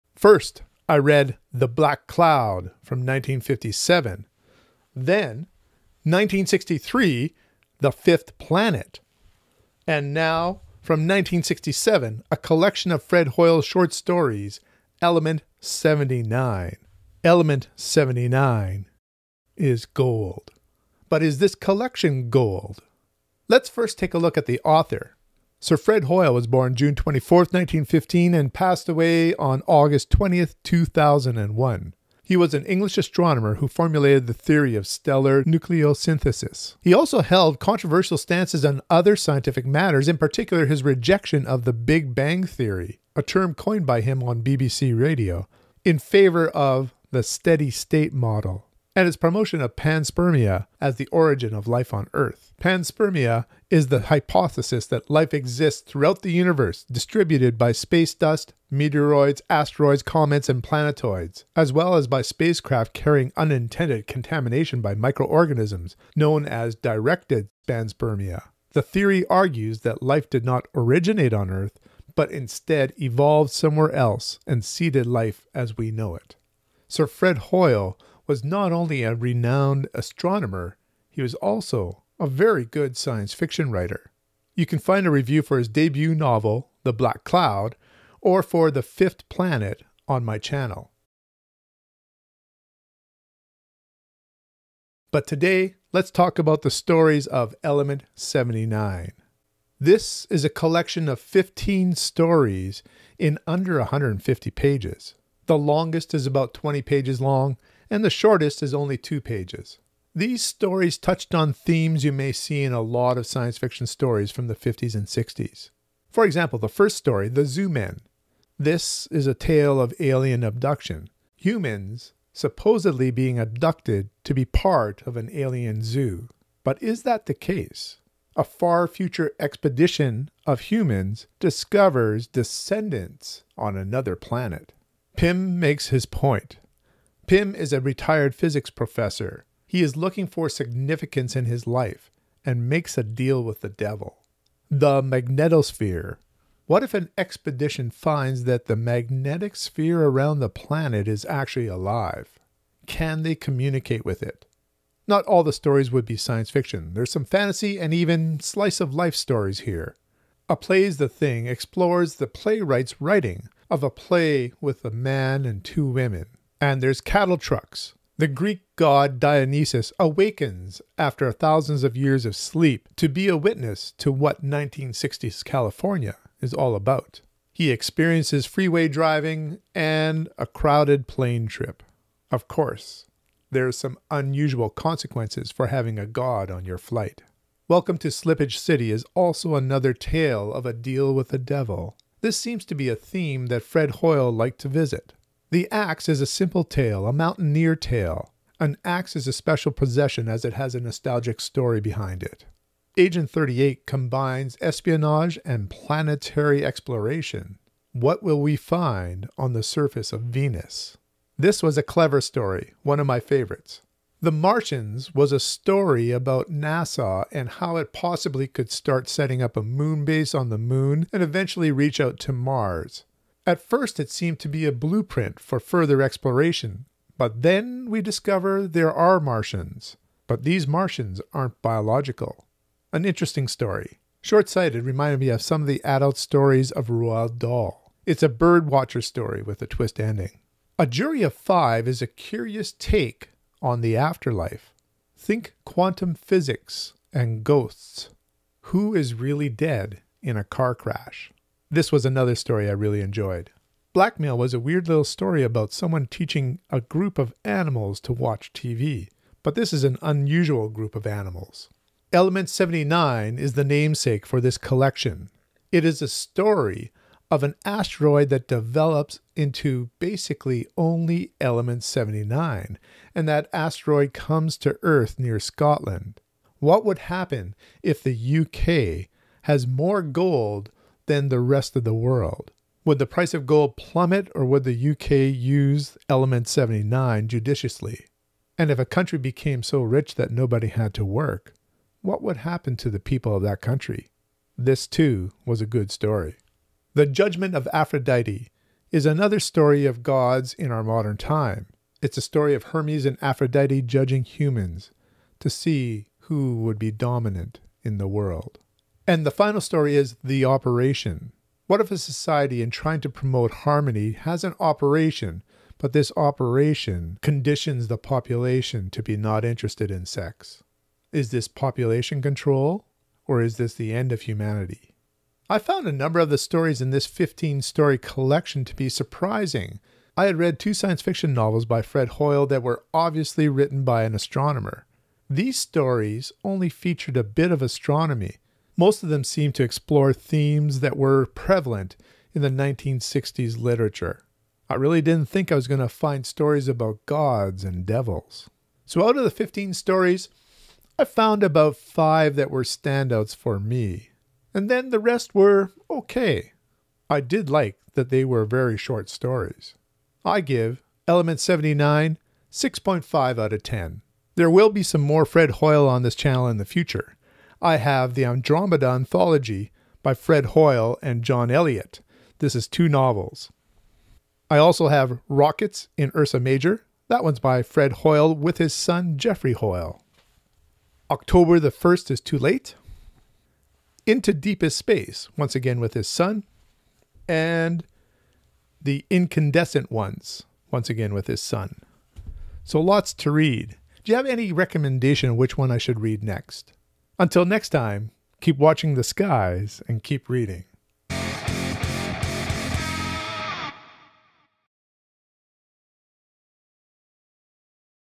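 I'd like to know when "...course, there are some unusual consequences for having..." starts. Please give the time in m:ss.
3:02.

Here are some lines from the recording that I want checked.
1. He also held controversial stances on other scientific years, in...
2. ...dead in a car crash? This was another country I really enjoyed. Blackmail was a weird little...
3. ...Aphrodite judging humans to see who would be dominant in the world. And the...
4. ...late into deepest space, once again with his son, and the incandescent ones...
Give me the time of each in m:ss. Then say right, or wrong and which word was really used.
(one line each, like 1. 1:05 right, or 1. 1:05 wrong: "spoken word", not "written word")
1. 0:36 wrong: "matters", not "years"
2. 4:09 wrong: "story", not "country"
3. 5:03 right
4. 6:22 right.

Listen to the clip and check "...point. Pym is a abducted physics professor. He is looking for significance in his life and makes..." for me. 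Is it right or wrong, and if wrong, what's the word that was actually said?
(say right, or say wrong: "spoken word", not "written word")
wrong: "retired", not "abducted".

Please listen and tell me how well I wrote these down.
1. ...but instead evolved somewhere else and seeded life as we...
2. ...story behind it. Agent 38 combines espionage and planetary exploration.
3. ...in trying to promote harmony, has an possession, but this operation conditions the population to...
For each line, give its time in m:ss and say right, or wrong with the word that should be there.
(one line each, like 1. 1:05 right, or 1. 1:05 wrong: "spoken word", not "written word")
1. 1:12 right
2. 3:21 right
3. 5:12 wrong: "operation", not "possession".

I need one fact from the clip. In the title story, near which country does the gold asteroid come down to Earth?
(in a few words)
Scotland.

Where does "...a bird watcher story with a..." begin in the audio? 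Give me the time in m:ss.
3:58.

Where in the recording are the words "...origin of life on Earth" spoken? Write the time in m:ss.
0:51.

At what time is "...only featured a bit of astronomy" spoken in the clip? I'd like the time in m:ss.
5:36.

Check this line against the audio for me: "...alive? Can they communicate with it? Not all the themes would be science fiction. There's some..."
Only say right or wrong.
wrong.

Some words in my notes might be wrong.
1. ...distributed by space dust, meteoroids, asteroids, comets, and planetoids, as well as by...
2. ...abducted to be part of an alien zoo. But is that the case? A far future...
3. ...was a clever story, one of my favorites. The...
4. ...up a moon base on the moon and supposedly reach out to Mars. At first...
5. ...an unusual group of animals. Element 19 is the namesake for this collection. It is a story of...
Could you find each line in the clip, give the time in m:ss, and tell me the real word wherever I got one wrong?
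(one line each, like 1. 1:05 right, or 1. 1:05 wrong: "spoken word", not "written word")
1. 0:56 right
2. 2:03 right
3. 3:31 right
4. 3:39 wrong: "eventually", not "supposedly"
5. 4:19 wrong: "79", not "19".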